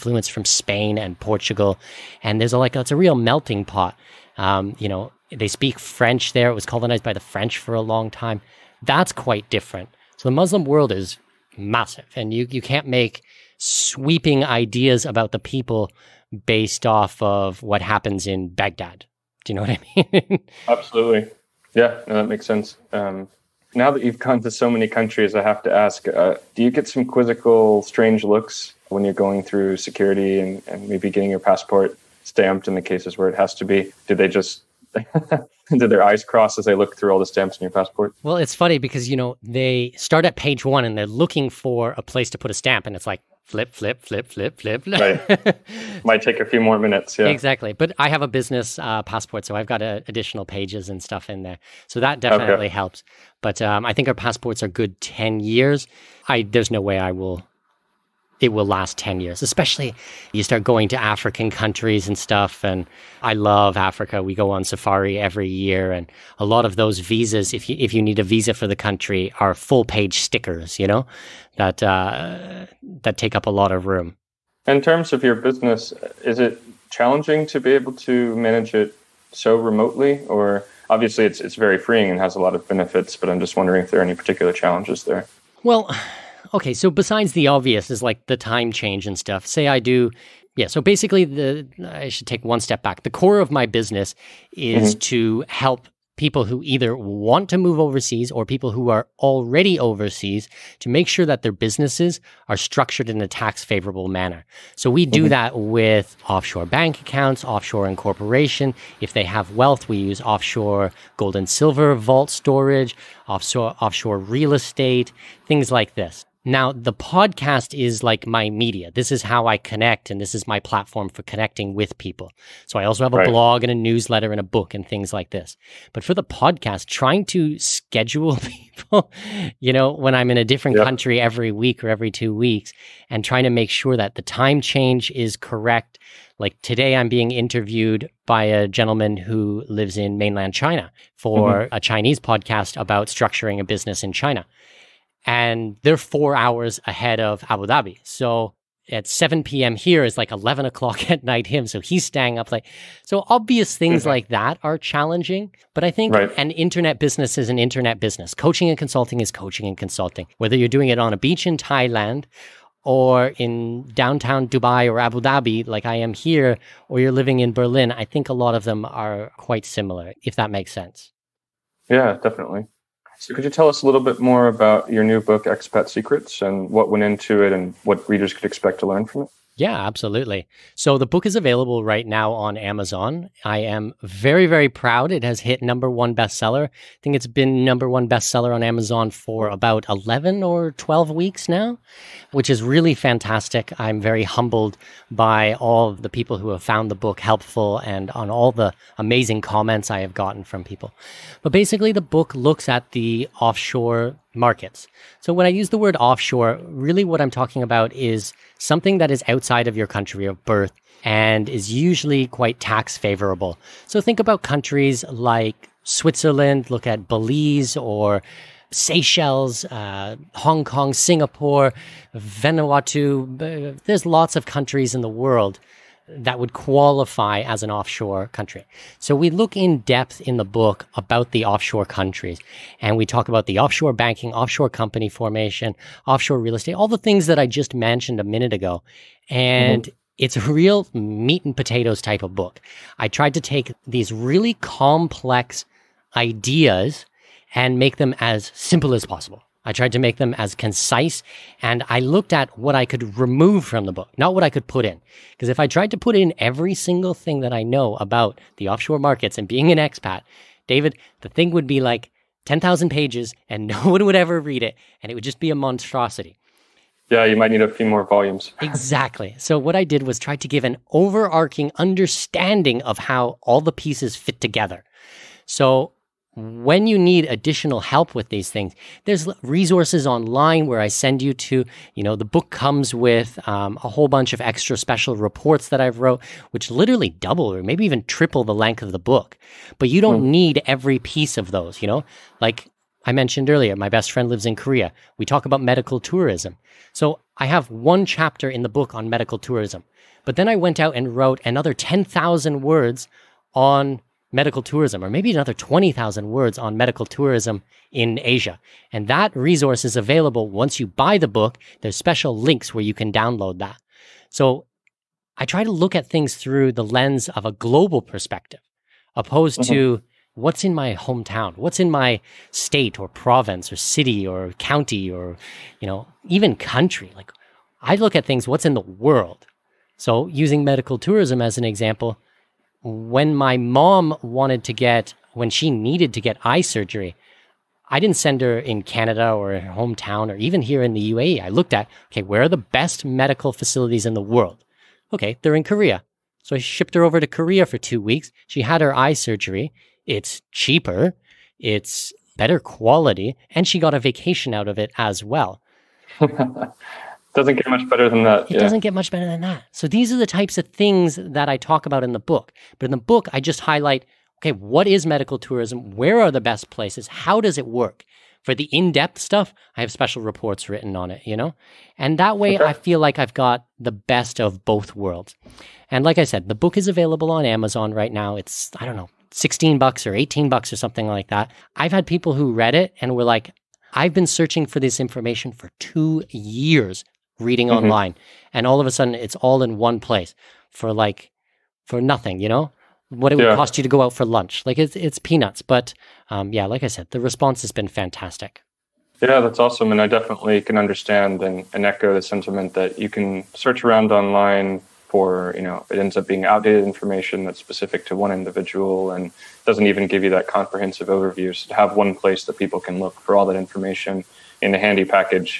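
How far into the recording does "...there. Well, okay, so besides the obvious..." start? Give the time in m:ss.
1:25.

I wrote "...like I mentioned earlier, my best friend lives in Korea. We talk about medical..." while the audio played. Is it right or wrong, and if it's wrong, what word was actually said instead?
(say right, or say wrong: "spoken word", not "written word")
right.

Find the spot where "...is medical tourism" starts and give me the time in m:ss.
6:04.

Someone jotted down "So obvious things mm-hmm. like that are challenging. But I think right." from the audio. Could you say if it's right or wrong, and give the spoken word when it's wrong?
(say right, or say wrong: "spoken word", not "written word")
right.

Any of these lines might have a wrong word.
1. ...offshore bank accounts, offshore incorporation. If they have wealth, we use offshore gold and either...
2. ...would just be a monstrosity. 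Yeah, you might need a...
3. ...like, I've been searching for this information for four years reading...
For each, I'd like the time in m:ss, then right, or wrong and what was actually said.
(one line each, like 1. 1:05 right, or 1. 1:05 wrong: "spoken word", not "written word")
1. 1:46 wrong: "silver", not "either"
2. 4:25 right
3. 6:23 wrong: "two", not "four".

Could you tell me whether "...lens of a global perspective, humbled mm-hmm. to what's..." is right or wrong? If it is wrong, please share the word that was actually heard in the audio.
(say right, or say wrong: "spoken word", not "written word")
wrong: "opposed", not "humbled".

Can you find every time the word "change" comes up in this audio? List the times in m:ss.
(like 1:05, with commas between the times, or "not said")
1:28, 2:14.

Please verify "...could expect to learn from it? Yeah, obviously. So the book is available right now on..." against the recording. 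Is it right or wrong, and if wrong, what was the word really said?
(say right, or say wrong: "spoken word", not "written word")
wrong: "absolutely", not "obviously".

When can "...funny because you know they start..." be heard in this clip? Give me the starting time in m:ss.
0:38.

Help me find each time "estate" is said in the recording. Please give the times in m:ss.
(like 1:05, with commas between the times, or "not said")
1:54, 3:56.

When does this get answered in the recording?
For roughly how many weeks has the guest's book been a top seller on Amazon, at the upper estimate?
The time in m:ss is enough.
3:10.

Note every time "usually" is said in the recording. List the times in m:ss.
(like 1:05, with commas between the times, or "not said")
3:31.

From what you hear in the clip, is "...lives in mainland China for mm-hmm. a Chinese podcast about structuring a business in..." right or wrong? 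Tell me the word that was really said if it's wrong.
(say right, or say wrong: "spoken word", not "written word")
right.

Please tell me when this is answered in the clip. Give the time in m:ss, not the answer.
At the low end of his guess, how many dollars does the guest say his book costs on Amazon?
6:19.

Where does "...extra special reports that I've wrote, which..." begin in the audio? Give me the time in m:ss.
4:44.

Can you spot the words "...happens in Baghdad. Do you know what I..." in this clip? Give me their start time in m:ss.
0:17.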